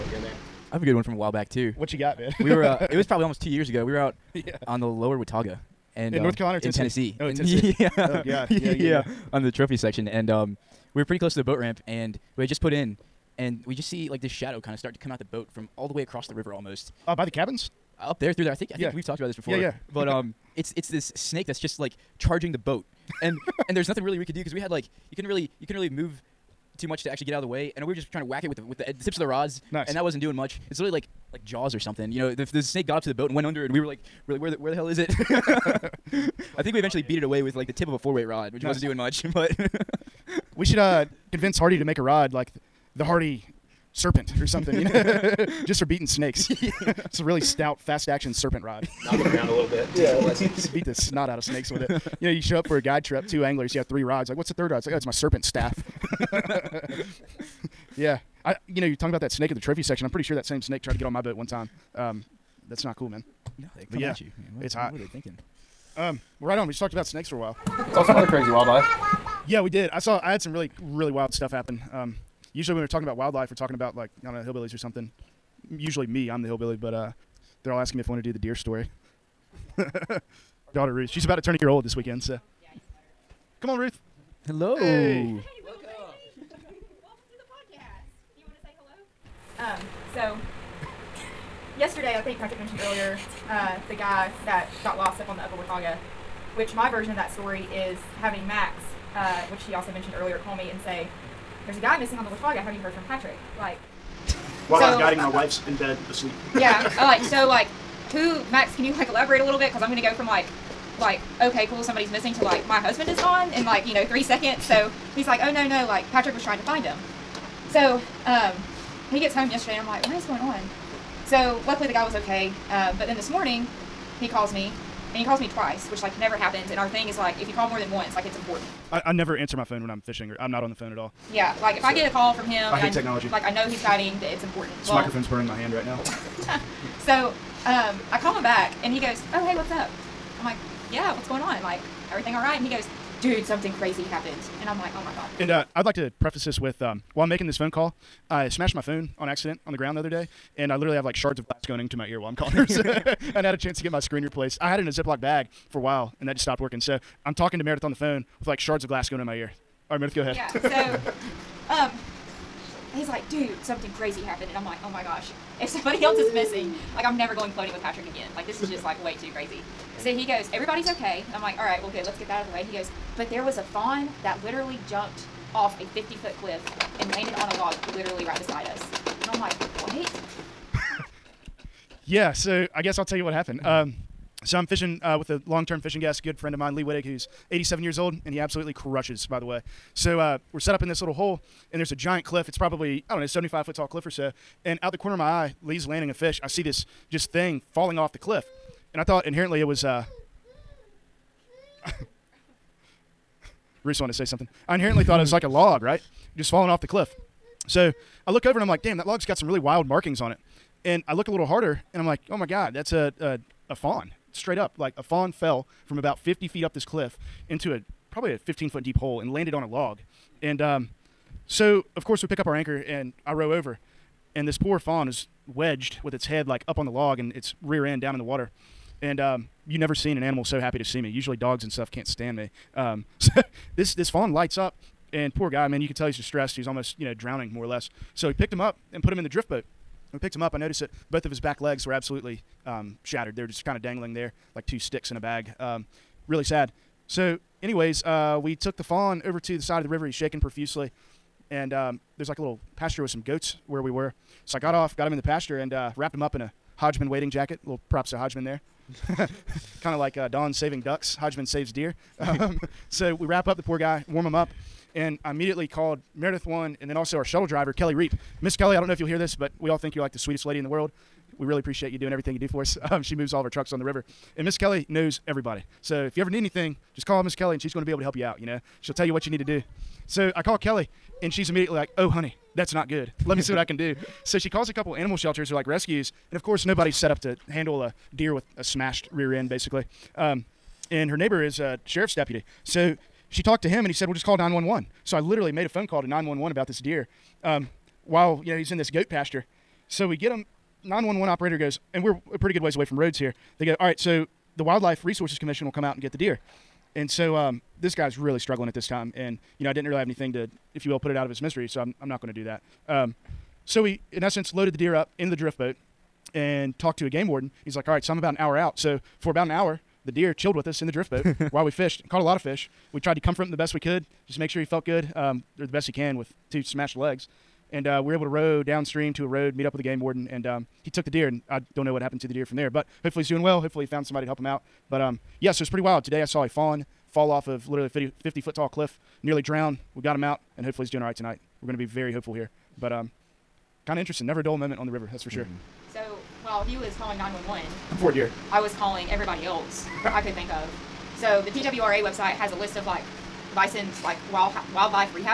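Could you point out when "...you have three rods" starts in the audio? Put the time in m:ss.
0:53.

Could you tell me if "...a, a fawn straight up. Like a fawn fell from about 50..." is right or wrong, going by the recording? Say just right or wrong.
right.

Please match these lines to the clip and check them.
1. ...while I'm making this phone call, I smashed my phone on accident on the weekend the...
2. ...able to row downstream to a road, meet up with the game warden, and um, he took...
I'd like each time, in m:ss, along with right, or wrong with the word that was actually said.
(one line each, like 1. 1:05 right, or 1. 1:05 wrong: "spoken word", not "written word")
1. 2:27 wrong: "ground", not "weekend"
2. 5:28 right.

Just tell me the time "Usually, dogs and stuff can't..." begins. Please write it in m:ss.
3:51.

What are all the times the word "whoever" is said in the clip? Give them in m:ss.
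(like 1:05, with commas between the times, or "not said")
not said.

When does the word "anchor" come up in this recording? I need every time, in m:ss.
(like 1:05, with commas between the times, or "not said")
3:42.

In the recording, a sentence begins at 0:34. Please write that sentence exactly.
We're like, where the where the hell is it?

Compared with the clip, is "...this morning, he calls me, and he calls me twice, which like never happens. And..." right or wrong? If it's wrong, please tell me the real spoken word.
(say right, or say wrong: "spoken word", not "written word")
right.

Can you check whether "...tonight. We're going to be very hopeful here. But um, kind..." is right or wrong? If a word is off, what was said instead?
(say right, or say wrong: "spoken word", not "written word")
right.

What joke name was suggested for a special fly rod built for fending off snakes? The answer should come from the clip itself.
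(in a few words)
Hardy Serpent.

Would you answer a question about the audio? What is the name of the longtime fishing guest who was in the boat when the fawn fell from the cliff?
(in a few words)
Lee Whittick.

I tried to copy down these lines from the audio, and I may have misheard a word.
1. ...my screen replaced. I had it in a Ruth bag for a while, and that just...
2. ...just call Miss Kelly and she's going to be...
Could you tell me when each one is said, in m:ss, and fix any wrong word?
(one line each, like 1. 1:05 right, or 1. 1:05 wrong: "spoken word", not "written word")
1. 2:33 wrong: "Ziploc", not "Ruth"
2. 4:36 right.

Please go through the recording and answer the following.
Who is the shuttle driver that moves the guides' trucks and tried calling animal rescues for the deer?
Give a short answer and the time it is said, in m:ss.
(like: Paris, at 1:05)
Kelly Reap, at 4:27.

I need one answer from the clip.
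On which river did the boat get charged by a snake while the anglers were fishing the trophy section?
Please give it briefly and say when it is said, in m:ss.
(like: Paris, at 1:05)
Lower Watauga, at 0:04.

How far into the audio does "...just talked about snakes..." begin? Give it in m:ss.
1:06.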